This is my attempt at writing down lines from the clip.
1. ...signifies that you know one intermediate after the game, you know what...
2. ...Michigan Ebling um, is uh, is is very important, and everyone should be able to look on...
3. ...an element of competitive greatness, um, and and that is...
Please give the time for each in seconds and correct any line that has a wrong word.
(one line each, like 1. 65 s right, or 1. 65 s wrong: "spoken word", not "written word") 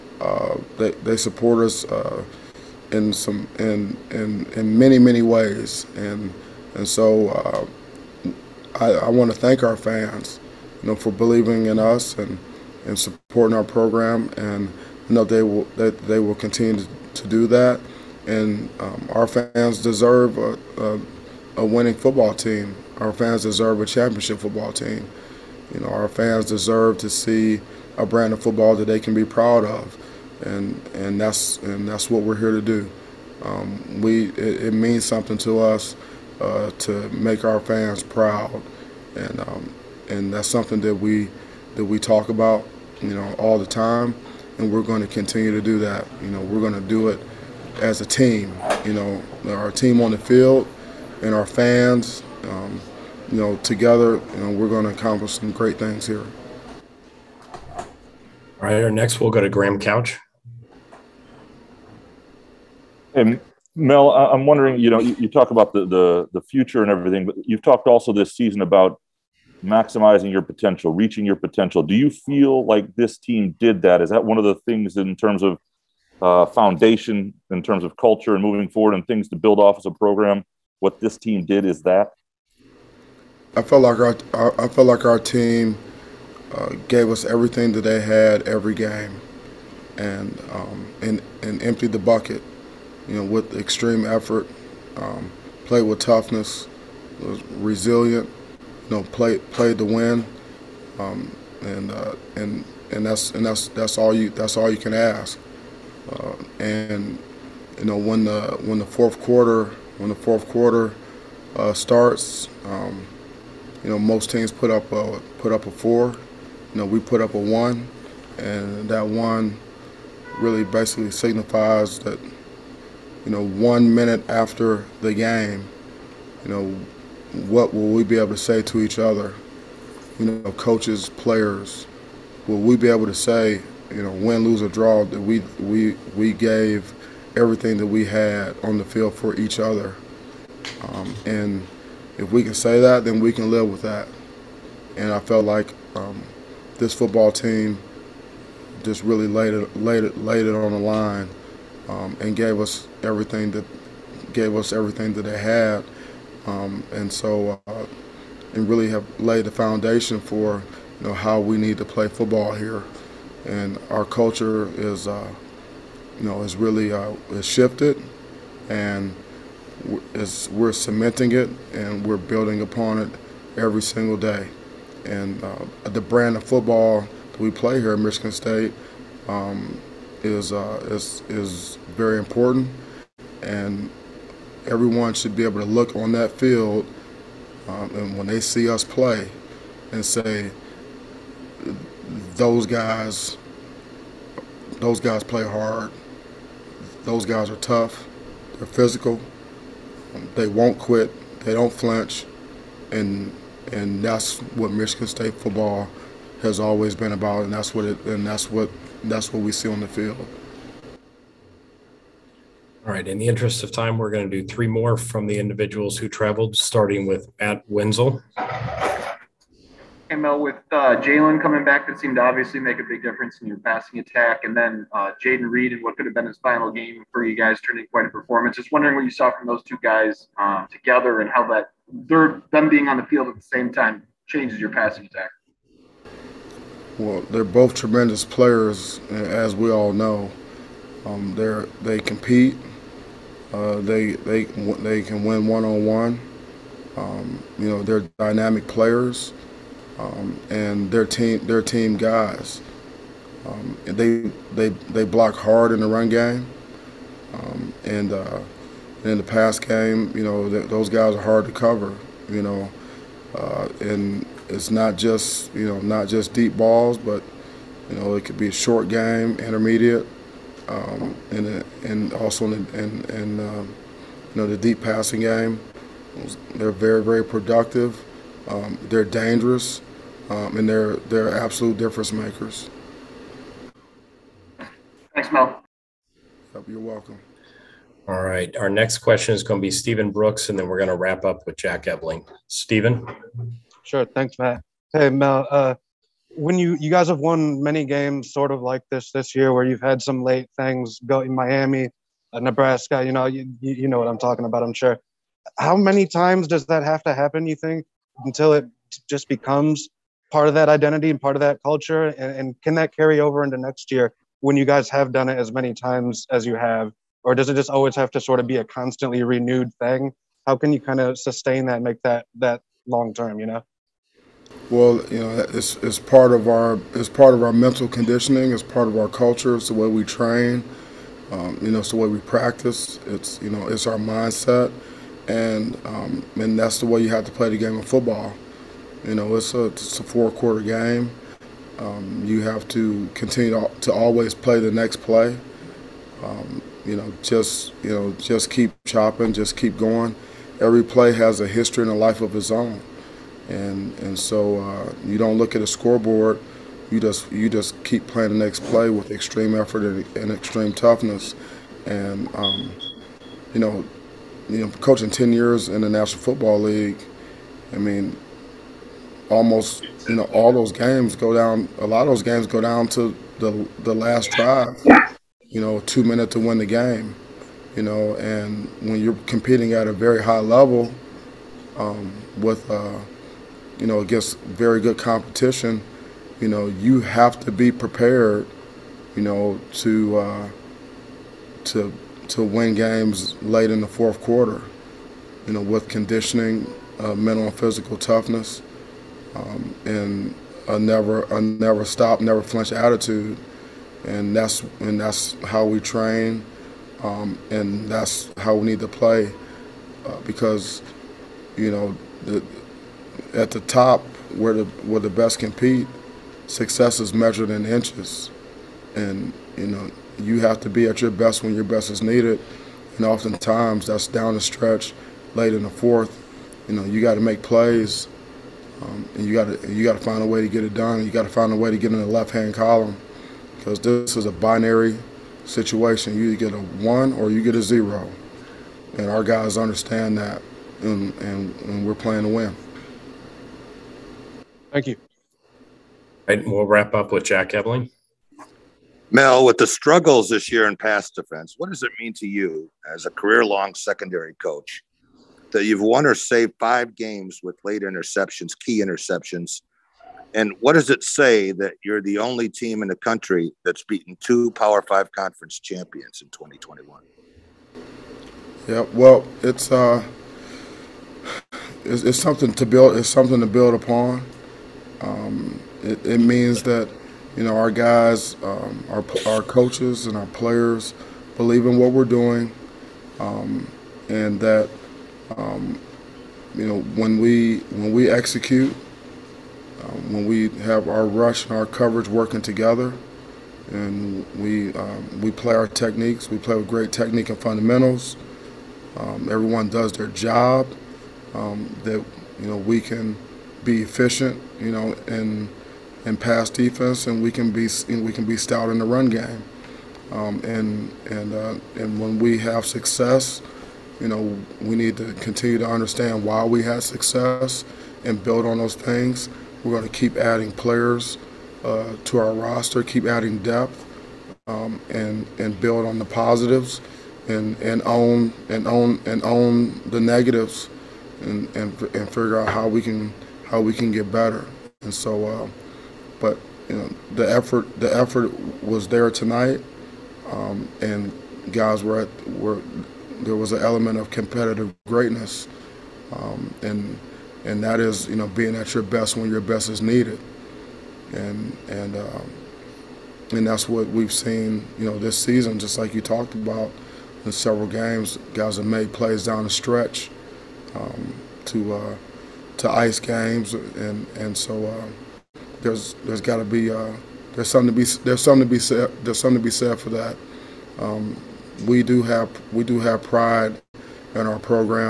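1. 121 s wrong: "minute", not "intermediate"
2. 177 s wrong: "State", not "Ebling"
3. 543 s right.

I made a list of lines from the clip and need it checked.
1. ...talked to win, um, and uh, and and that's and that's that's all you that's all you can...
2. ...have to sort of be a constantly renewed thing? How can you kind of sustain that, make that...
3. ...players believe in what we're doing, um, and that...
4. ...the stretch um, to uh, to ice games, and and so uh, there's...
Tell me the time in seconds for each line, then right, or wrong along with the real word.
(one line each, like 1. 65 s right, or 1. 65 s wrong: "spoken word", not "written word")
1. 99 s wrong: "played", not "talked"
2. 317 s right
3. 480 s right
4. 559 s right.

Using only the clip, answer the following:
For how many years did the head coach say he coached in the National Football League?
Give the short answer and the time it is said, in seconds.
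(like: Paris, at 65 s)
10, at 365 s.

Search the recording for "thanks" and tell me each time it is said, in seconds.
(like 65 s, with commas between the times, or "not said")
9 s, 285 s, 294 s, 444 s.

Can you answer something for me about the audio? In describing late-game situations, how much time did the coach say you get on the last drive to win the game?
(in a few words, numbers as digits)
2 minutes.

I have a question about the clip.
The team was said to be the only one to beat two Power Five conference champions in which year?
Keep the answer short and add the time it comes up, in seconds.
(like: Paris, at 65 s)
2021, at 466 s.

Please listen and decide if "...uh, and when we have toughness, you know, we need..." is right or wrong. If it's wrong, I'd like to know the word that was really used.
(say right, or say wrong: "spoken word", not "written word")
wrong: "success", not "toughness".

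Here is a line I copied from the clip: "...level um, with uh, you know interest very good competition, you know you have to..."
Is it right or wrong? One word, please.
wrong.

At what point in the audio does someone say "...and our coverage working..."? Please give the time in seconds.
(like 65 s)
491 s.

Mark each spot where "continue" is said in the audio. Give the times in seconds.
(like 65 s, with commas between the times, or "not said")
16 s, 45 s, 343 s, 515 s.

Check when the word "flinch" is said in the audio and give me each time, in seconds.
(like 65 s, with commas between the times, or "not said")
201 s, 402 s.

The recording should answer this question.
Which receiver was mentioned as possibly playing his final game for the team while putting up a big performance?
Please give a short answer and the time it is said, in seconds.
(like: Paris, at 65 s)
Jayden Reed, at 225 s.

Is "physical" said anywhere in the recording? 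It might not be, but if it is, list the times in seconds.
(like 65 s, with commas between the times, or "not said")
198 s, 397 s.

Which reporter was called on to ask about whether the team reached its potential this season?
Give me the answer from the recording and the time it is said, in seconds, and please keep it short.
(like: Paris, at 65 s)
Graham Couch, at 59 s.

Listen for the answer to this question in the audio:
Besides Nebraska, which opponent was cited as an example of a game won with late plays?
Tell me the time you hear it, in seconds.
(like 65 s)
301 s.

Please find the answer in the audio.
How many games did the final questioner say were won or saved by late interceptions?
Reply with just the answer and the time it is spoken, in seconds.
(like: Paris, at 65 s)
5, at 456 s.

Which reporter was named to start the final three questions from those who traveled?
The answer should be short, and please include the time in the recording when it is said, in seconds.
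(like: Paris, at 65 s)
Matt Wenzel, at 217 s.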